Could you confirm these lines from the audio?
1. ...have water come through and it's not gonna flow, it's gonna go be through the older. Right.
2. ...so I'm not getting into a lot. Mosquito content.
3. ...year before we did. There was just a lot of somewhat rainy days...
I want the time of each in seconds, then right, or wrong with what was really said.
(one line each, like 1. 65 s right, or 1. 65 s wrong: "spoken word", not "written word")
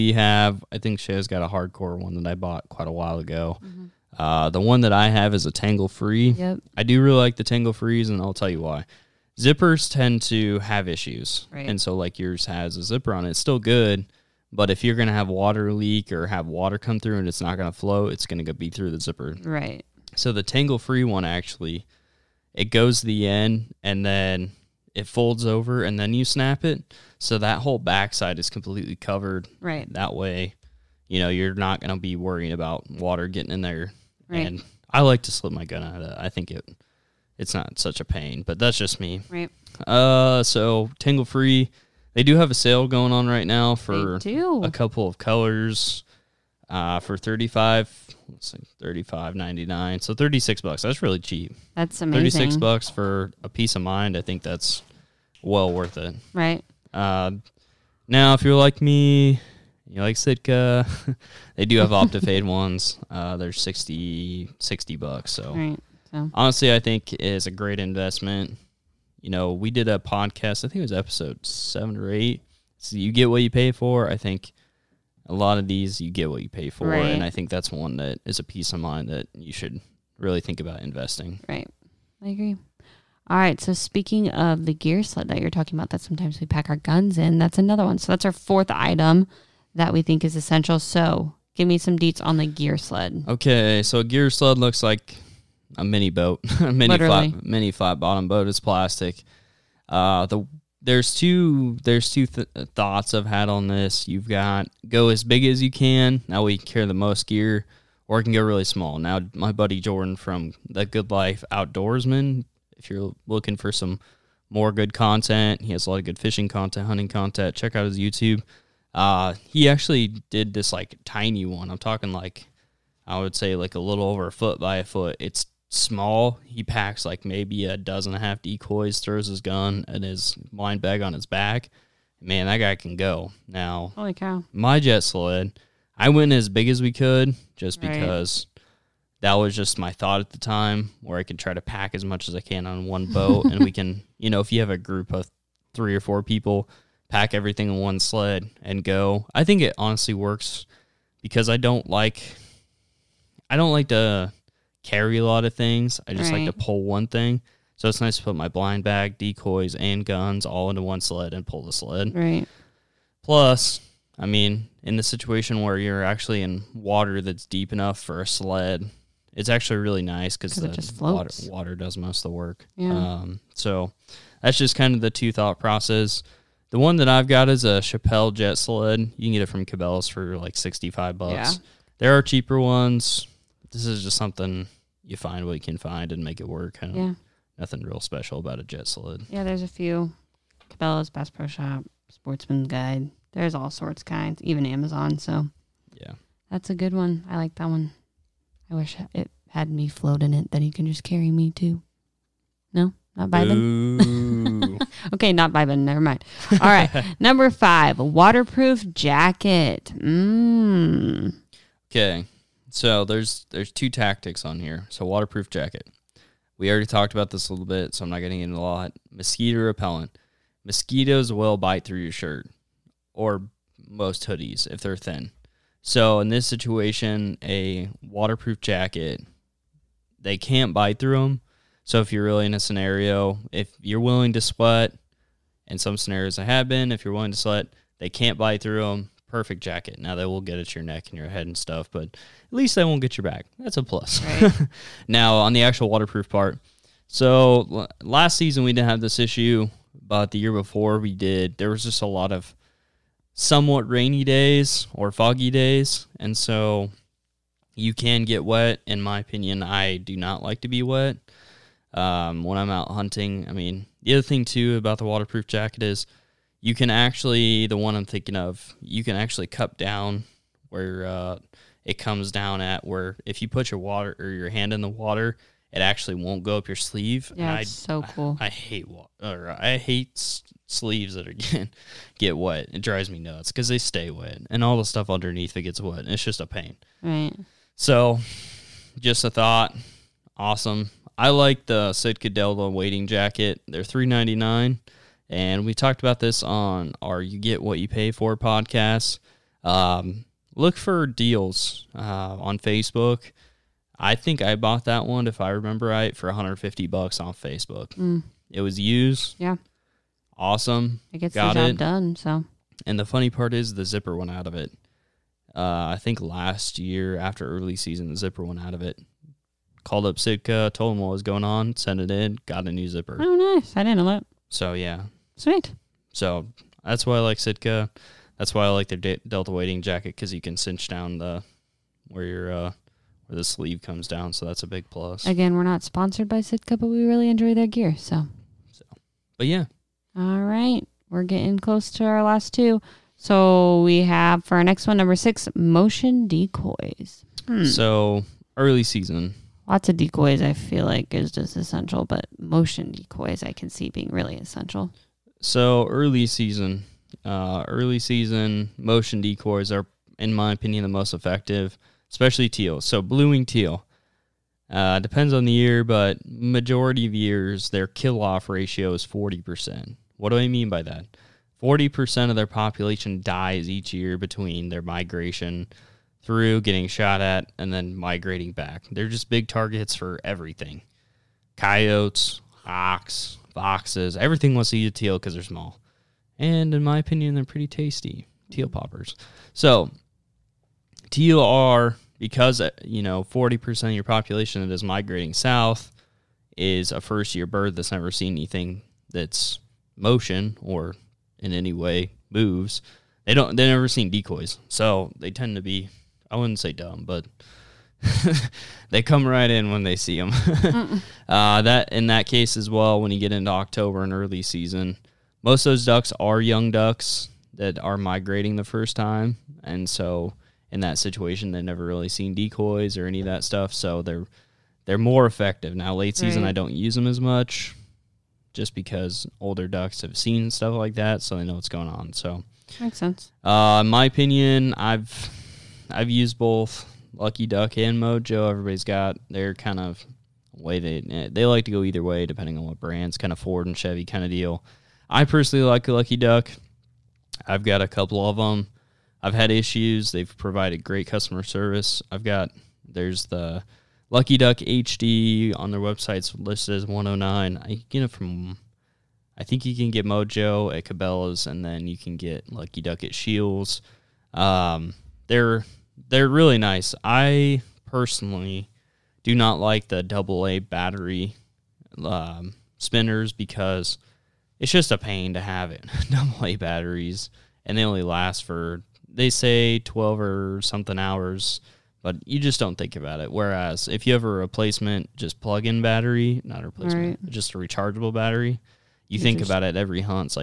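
1. 16 s wrong: "zipper", not "older"
2. 217 s wrong: "repellent", not "content"
3. 250 s right.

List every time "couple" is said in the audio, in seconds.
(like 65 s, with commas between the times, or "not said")
44 s, 447 s.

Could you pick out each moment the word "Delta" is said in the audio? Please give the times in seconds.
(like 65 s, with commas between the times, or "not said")
292 s, 329 s.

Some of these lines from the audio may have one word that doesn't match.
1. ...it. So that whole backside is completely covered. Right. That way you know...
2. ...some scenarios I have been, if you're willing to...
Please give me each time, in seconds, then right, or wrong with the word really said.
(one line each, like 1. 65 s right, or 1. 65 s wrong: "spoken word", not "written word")
1. 26 s right
2. 235 s right.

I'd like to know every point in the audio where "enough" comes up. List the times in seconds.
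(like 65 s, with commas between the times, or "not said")
167 s.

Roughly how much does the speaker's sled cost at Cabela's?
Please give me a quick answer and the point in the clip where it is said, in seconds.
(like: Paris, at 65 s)
$65, at 180 s.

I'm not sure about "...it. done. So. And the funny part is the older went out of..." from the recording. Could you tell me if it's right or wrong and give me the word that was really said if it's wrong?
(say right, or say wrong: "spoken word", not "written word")
wrong: "zipper", not "older".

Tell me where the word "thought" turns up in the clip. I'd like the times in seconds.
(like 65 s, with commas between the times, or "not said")
102 s, 139 s, 175 s, 289 s.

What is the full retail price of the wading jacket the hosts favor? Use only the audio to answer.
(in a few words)
$399.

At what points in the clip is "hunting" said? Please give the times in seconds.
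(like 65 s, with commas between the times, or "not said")
116 s, 262 s.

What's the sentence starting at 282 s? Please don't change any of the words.
It drives me nuts because they stay wet, and all the stuff underneath it gets wet.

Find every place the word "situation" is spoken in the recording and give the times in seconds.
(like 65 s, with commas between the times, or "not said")
165 s, 226 s, 420 s.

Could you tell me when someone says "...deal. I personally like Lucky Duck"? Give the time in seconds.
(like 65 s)
444 s.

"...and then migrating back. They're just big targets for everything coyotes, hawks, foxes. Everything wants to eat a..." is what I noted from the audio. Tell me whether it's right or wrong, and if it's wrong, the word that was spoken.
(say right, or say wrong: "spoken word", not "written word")
right.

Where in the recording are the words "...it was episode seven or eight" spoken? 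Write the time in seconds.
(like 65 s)
70 s.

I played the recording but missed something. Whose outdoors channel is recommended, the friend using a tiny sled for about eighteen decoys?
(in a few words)
Jordan.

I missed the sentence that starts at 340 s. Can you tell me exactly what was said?
All right, we're getting close to our last two.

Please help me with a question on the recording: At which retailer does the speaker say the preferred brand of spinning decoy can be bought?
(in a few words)
Scheels.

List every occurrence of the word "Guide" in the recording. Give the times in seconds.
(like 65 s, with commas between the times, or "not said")
192 s.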